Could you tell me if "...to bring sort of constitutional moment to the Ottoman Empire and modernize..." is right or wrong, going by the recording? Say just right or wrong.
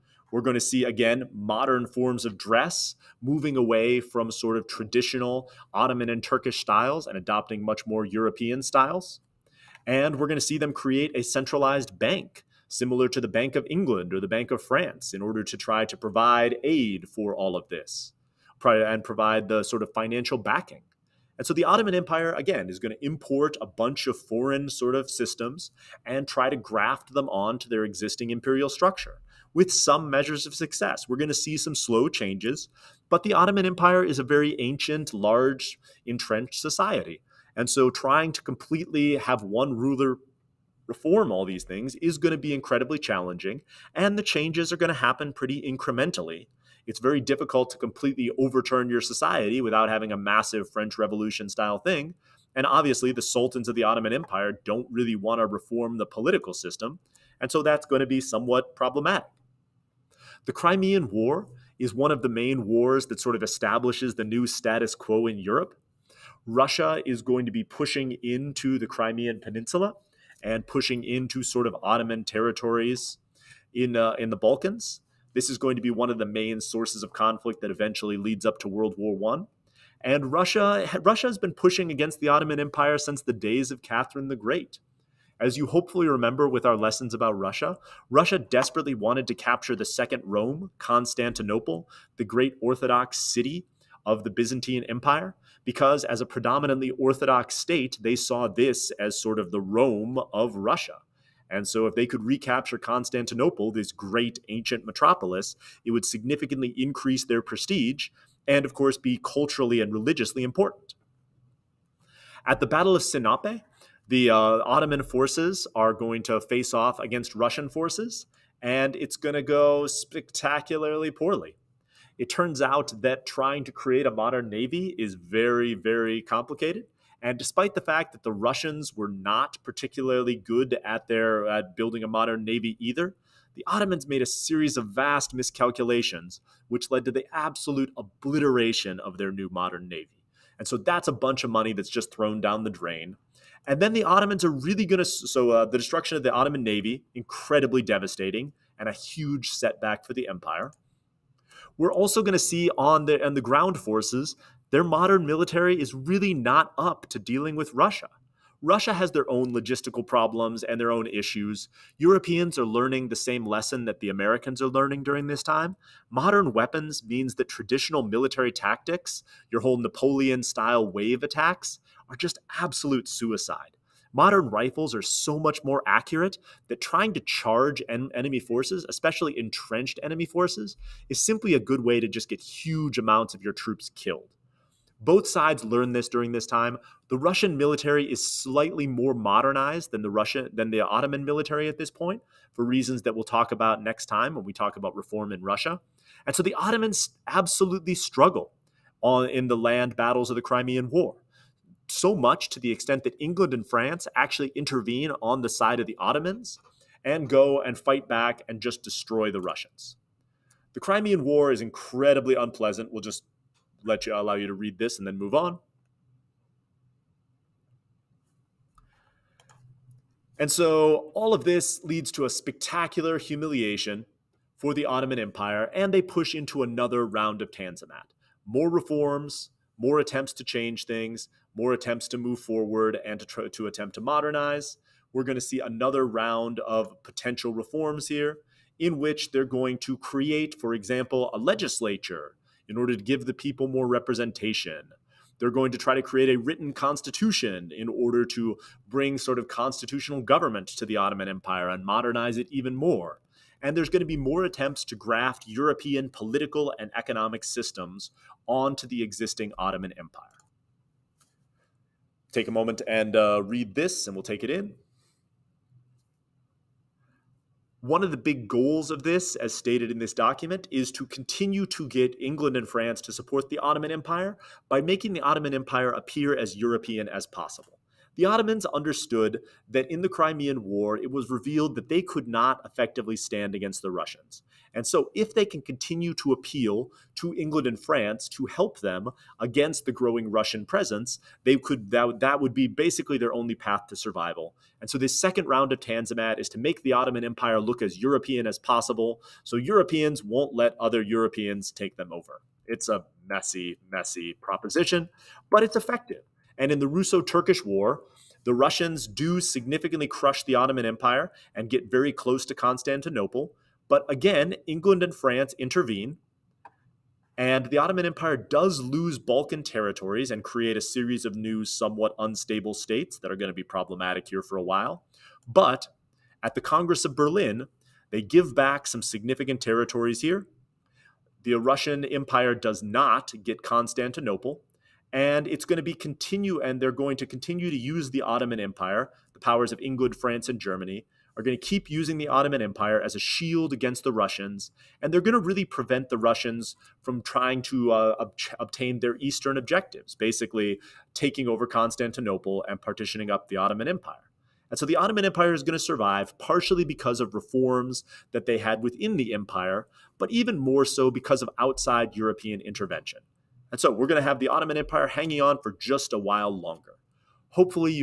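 wrong.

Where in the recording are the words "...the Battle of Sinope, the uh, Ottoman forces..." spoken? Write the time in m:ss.
1:52.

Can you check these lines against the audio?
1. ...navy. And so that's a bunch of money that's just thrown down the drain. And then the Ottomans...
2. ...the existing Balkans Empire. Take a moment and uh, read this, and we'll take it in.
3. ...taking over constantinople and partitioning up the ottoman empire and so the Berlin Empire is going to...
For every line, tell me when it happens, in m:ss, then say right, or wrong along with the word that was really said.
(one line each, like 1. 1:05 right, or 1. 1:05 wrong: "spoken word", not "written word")
1. 2:19 right
2. 4:18 wrong: "Ottoman", not "Balkans"
3. 5:51 wrong: "Ottoman", not "Berlin".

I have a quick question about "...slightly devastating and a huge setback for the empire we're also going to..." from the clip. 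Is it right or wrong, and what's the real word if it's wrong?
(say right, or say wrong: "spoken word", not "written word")
wrong: "incredibly", not "slightly".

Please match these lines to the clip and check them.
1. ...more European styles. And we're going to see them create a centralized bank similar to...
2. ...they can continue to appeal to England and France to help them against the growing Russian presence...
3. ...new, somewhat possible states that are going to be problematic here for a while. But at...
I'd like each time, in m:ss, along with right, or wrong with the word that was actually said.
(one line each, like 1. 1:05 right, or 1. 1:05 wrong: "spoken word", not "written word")
1. 0:07 right
2. 4:45 right
3. 5:21 wrong: "unstable", not "possible".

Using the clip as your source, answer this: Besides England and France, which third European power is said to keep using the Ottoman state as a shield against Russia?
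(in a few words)
Germany.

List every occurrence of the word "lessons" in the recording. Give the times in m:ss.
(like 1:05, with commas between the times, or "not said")
1:26, 2:43.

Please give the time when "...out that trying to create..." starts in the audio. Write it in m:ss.
2:02.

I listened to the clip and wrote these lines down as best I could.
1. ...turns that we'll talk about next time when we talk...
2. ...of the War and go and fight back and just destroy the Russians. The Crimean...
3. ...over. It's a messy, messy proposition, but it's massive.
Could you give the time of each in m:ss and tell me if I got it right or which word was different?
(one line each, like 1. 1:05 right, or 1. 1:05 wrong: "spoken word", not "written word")
1. 3:12 wrong: "reasons", not "turns"
2. 3:25 wrong: "Ottomans", not "War"
3. 5:02 wrong: "effective", not "massive".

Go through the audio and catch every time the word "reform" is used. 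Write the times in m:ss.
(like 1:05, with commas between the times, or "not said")
0:40, 0:55, 3:14, 3:48, 3:57, 5:57.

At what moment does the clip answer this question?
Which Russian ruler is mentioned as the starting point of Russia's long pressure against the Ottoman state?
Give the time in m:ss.
1:23.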